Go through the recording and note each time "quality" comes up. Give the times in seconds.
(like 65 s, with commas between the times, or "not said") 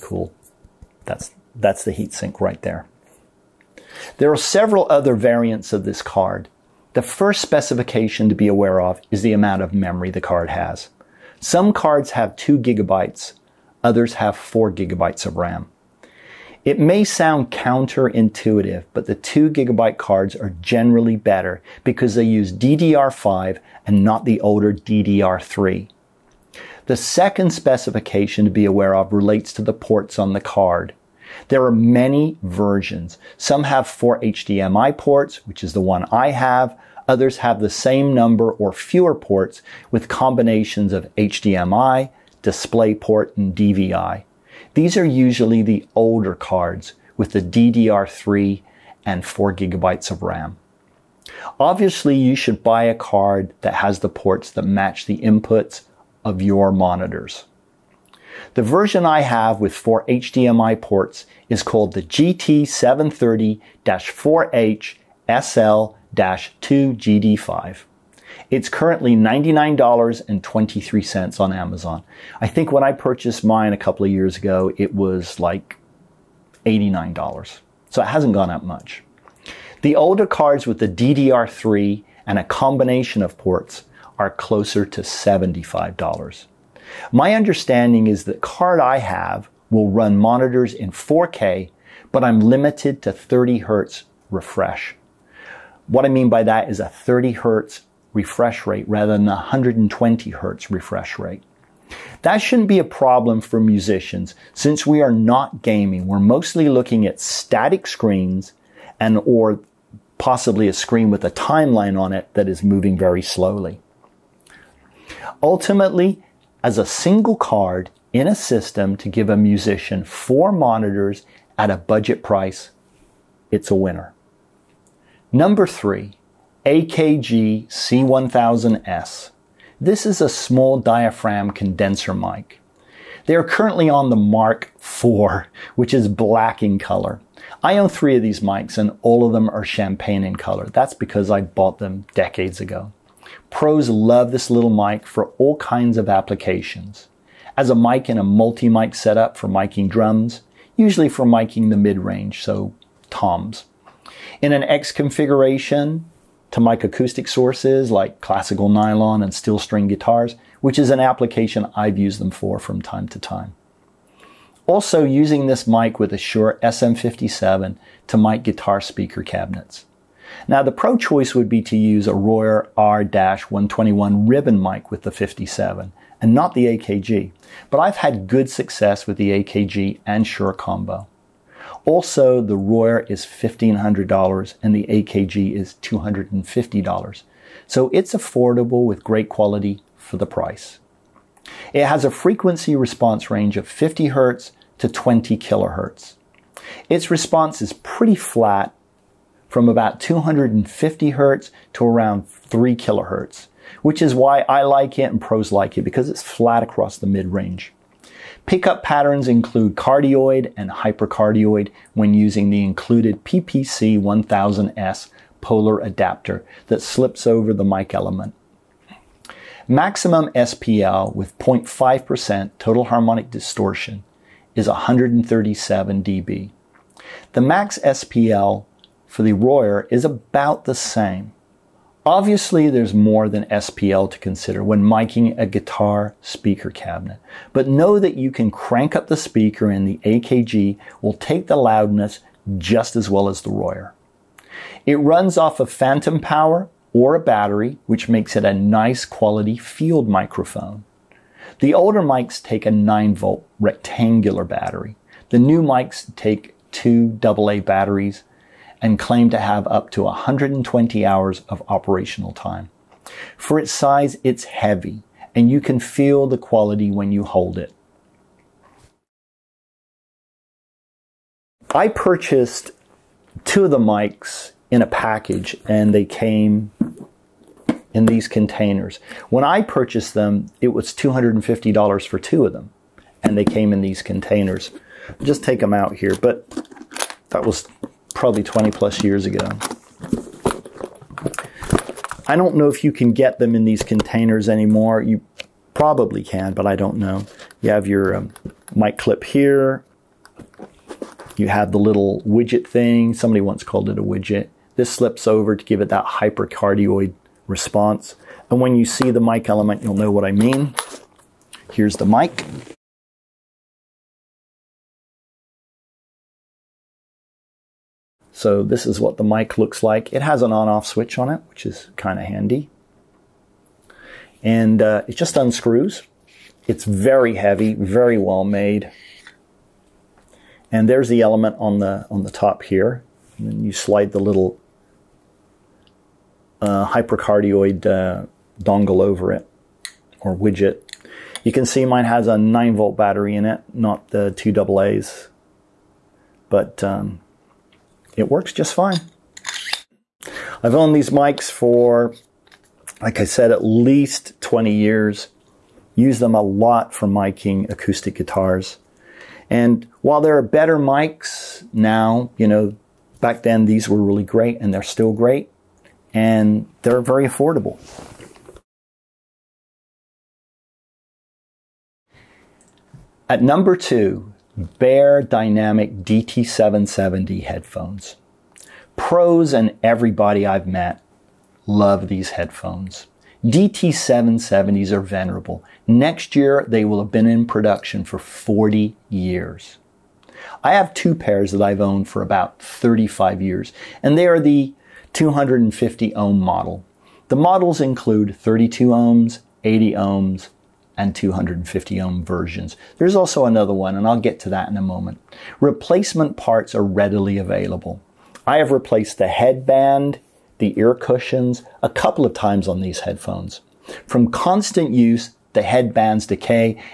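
189 s, 249 s, 266 s.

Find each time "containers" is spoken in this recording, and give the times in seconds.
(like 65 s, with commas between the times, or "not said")
278 s, 284 s, 293 s.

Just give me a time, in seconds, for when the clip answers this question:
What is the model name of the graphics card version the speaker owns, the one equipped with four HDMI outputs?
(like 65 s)
62 s.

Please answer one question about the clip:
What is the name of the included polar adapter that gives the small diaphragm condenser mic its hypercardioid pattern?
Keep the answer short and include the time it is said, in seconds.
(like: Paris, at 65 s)
PPC 1000S, at 213 s.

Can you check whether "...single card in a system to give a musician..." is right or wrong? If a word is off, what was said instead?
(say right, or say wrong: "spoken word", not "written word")
right.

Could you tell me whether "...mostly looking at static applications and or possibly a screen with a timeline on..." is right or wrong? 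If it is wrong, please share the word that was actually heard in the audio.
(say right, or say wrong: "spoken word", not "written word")
wrong: "screens", not "applications".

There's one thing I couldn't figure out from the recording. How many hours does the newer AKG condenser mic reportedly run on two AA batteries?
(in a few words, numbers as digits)
120 hours.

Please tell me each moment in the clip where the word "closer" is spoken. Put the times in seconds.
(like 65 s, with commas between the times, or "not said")
84 s.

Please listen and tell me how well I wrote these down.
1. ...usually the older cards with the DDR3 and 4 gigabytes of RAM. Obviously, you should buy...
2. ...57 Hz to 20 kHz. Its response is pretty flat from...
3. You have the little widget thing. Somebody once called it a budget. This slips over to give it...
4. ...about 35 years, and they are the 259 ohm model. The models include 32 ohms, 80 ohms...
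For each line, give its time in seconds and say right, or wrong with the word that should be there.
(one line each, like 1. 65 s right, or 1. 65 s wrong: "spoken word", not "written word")
1. 45 s right
2. 193 s wrong: "50", not "57"
3. 301 s wrong: "widget", not "budget"
4. 392 s wrong: "250", not "259".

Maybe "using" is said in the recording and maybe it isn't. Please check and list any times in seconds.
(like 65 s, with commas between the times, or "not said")
165 s, 212 s.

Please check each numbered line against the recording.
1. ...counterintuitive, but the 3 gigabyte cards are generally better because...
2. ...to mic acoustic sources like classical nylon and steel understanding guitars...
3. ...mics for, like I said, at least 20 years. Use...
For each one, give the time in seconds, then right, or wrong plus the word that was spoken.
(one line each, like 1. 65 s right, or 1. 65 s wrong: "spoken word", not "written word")
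1. 17 s wrong: "2", not "3"
2. 156 s wrong: "string", not "understanding"
3. 351 s right.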